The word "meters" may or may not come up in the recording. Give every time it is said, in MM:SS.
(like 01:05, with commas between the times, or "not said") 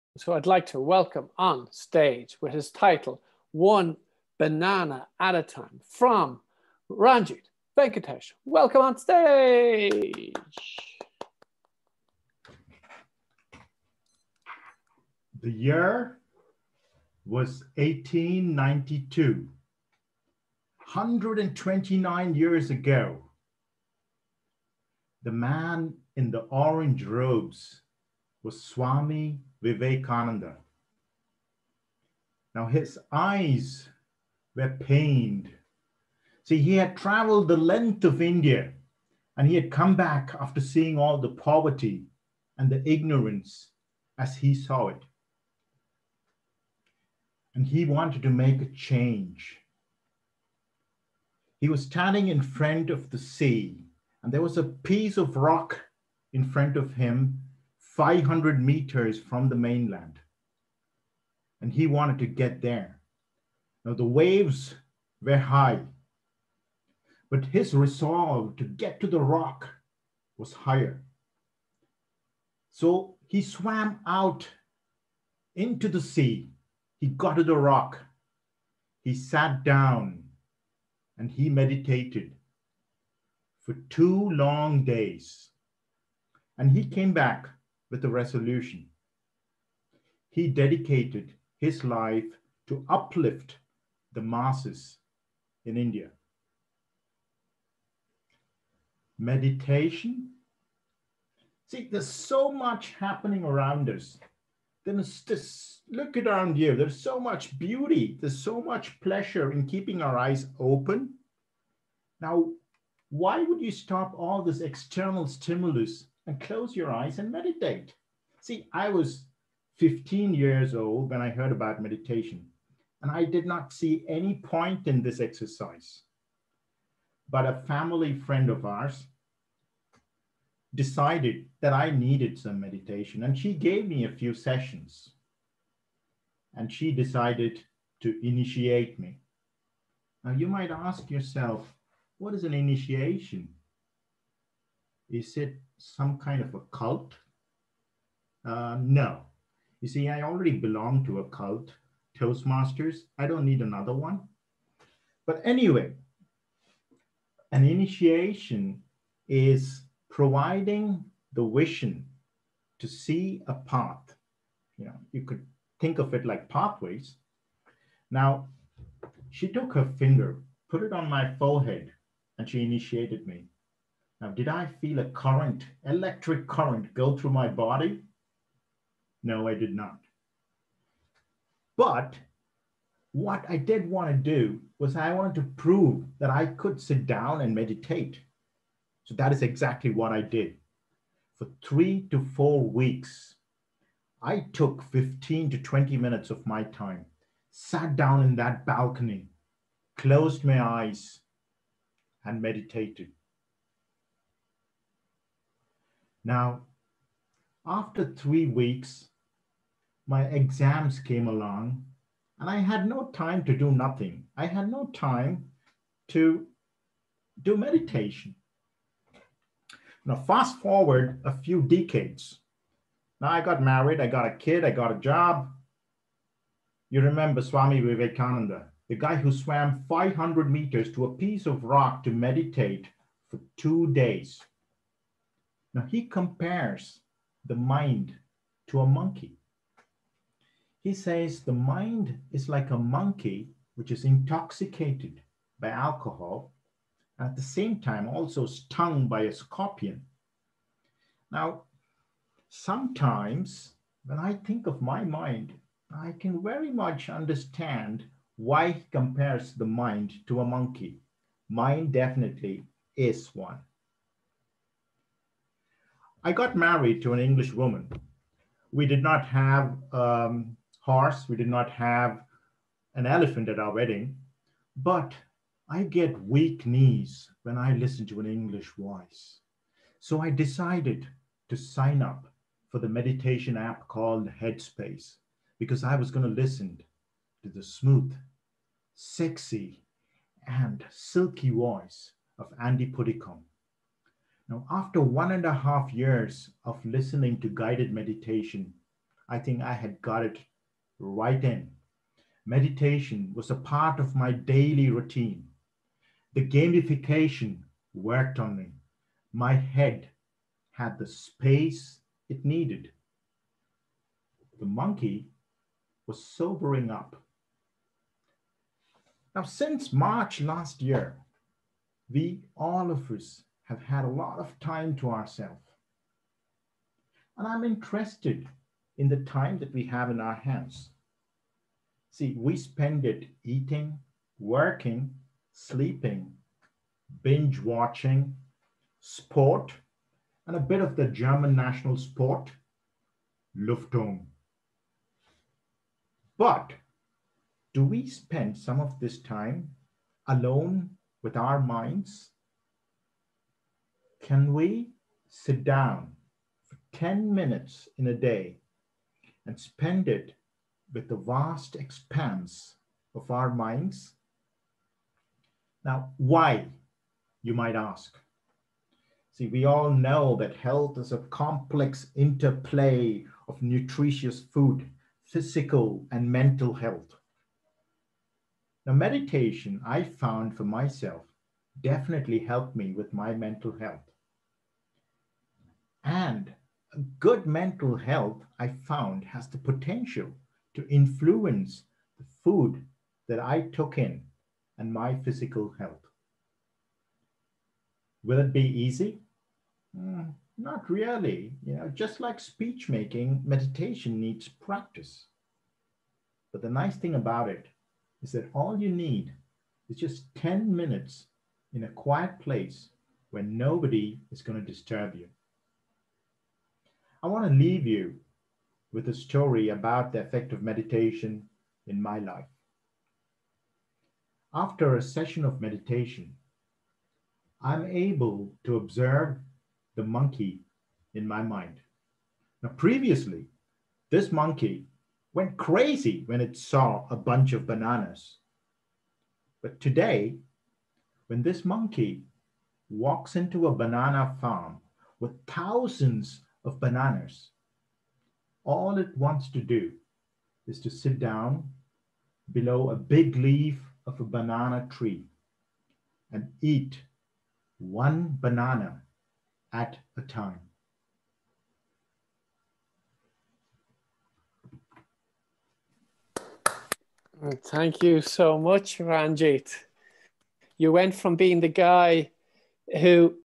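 00:58, 03:50.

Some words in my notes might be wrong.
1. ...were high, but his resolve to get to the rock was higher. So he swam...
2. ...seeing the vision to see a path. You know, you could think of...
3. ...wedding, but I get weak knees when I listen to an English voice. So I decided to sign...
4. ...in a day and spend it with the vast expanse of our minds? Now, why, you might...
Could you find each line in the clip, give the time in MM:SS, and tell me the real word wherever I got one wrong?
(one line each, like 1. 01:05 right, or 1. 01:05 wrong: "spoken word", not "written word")
1. 01:05 right
2. 02:40 wrong: "providing", not "seeing"
3. 04:33 right
4. 05:57 right.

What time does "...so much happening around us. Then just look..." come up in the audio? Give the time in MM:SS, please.
01:42.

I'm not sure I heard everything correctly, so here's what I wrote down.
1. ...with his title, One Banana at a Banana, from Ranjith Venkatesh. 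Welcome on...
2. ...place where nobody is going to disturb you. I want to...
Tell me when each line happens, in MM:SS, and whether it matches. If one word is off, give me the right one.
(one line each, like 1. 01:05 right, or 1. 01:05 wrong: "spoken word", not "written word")
1. 00:02 wrong: "Time", not "Banana"
2. 06:52 right.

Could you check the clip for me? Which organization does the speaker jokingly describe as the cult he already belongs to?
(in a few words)
Toastmasters.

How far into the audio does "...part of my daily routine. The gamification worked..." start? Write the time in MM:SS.
05:03.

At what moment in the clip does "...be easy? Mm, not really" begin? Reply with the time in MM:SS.
06:38.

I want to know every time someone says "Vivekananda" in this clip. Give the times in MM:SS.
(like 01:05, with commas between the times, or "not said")
00:29, 03:47.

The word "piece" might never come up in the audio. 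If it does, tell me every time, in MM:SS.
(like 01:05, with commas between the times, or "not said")
00:54, 03:51.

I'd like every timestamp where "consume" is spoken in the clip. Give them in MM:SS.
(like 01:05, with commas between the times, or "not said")
not said.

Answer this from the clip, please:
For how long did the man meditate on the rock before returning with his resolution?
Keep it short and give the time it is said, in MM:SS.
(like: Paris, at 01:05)
two days, at 01:23.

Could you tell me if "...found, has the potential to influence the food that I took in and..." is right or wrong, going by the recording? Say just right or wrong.
right.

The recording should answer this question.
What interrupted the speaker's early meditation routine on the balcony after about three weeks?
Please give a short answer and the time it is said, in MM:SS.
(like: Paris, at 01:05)
exams, at 03:30.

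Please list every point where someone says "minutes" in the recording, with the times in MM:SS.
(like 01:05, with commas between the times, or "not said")
03:15, 05:57, 06:50.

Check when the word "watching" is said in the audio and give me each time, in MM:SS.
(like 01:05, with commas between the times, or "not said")
05:37.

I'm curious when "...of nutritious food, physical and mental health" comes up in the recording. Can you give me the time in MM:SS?
06:13.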